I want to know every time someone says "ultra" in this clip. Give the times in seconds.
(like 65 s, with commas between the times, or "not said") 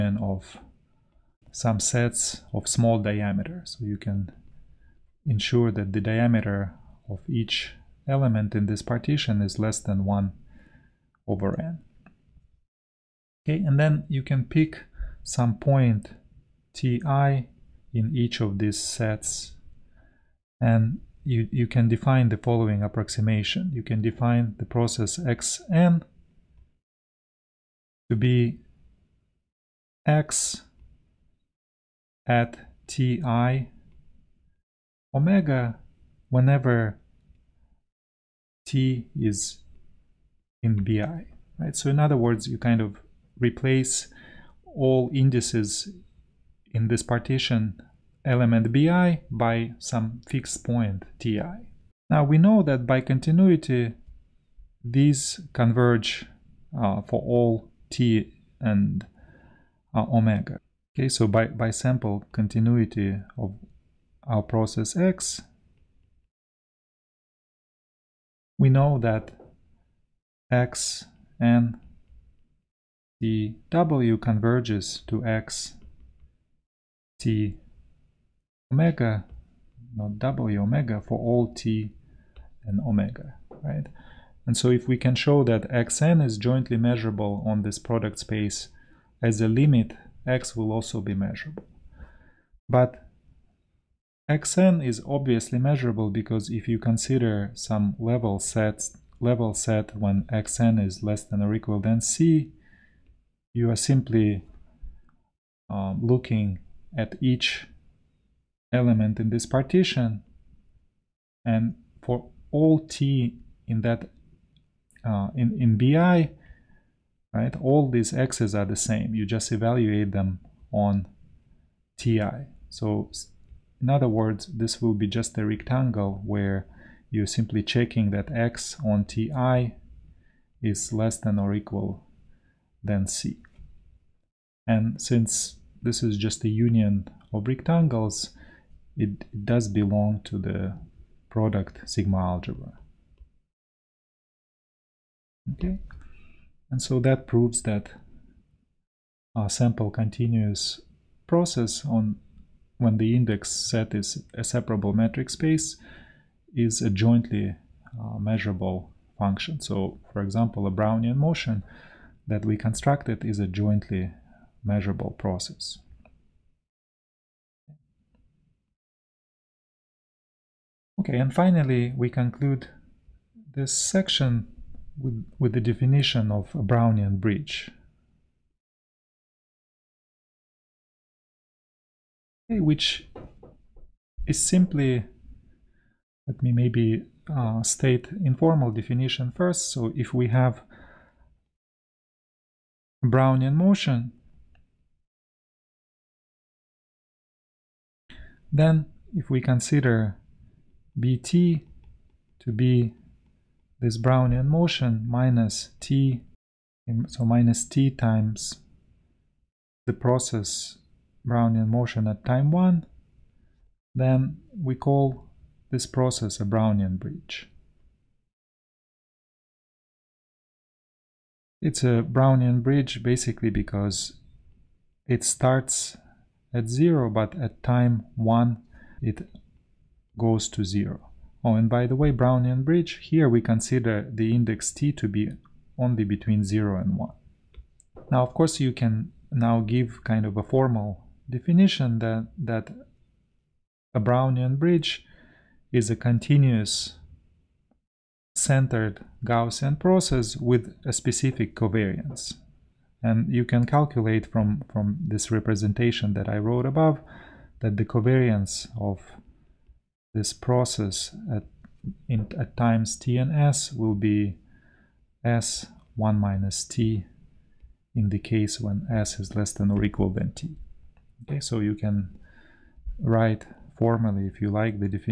not said.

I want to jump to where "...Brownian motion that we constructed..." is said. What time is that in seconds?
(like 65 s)
160 s.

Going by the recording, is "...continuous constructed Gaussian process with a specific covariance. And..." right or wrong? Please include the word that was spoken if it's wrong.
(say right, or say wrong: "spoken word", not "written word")
wrong: "centered", not "constructed".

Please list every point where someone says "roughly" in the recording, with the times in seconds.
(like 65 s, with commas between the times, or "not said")
not said.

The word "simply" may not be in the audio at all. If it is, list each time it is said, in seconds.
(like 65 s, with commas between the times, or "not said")
103 s, 127 s, 184 s.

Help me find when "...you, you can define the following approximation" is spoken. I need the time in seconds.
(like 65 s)
21 s.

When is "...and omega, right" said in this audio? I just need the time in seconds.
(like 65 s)
82 s.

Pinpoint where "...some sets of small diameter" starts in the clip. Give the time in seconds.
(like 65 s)
1 s.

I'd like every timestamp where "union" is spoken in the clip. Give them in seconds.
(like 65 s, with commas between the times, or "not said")
136 s.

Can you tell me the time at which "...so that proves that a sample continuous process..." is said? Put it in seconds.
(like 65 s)
146 s.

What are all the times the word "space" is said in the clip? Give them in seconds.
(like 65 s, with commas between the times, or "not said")
88 s, 155 s.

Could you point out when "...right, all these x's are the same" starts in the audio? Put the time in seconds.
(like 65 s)
117 s.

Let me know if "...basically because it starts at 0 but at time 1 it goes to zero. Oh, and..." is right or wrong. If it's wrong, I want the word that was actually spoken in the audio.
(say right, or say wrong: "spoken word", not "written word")
right.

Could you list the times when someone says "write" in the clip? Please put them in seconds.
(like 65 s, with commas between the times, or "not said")
272 s.